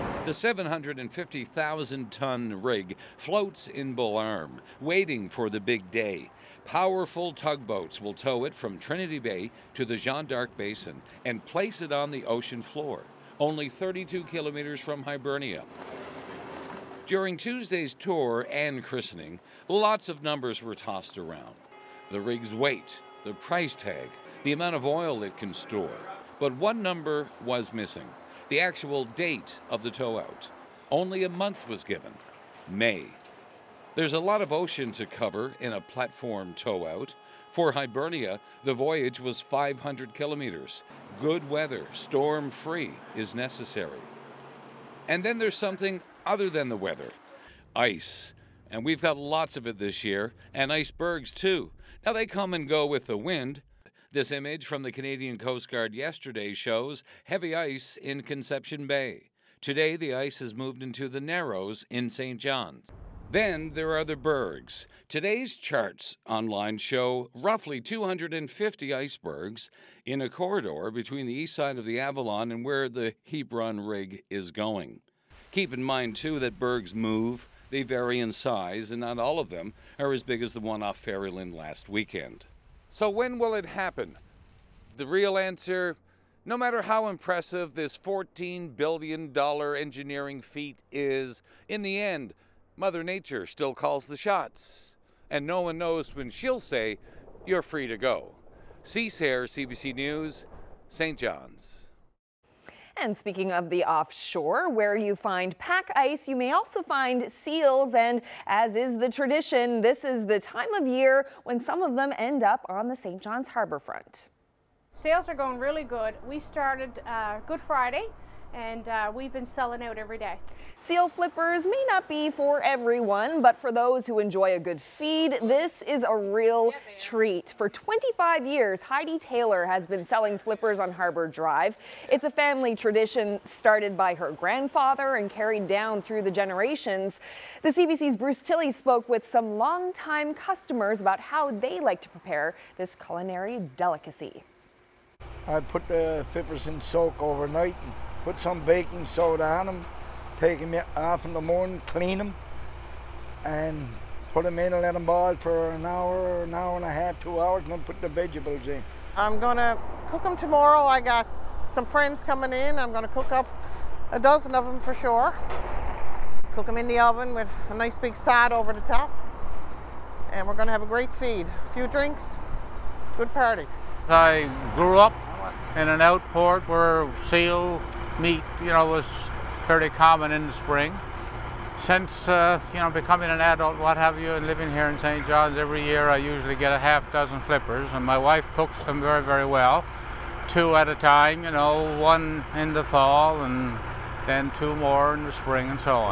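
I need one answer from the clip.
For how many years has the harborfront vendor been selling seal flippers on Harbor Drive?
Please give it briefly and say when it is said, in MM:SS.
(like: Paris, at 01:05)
25 years, at 02:07.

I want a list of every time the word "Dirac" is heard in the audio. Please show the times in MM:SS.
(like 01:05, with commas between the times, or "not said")
not said.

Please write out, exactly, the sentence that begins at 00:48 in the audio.
And we've got lots of it this year, and icebergs too.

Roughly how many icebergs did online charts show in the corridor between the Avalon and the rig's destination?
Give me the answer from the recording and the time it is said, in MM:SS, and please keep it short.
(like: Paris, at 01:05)
250, at 01:07.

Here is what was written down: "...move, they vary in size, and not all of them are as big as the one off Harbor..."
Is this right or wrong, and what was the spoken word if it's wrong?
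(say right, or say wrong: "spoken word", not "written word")
wrong: "Ferryland", not "Harbor".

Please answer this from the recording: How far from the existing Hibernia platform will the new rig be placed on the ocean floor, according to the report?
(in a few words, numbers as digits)
32 kilometers.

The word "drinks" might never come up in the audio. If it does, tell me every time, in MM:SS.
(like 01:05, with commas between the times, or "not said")
02:51.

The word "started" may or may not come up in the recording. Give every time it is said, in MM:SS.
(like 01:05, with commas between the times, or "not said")
01:56, 02:13.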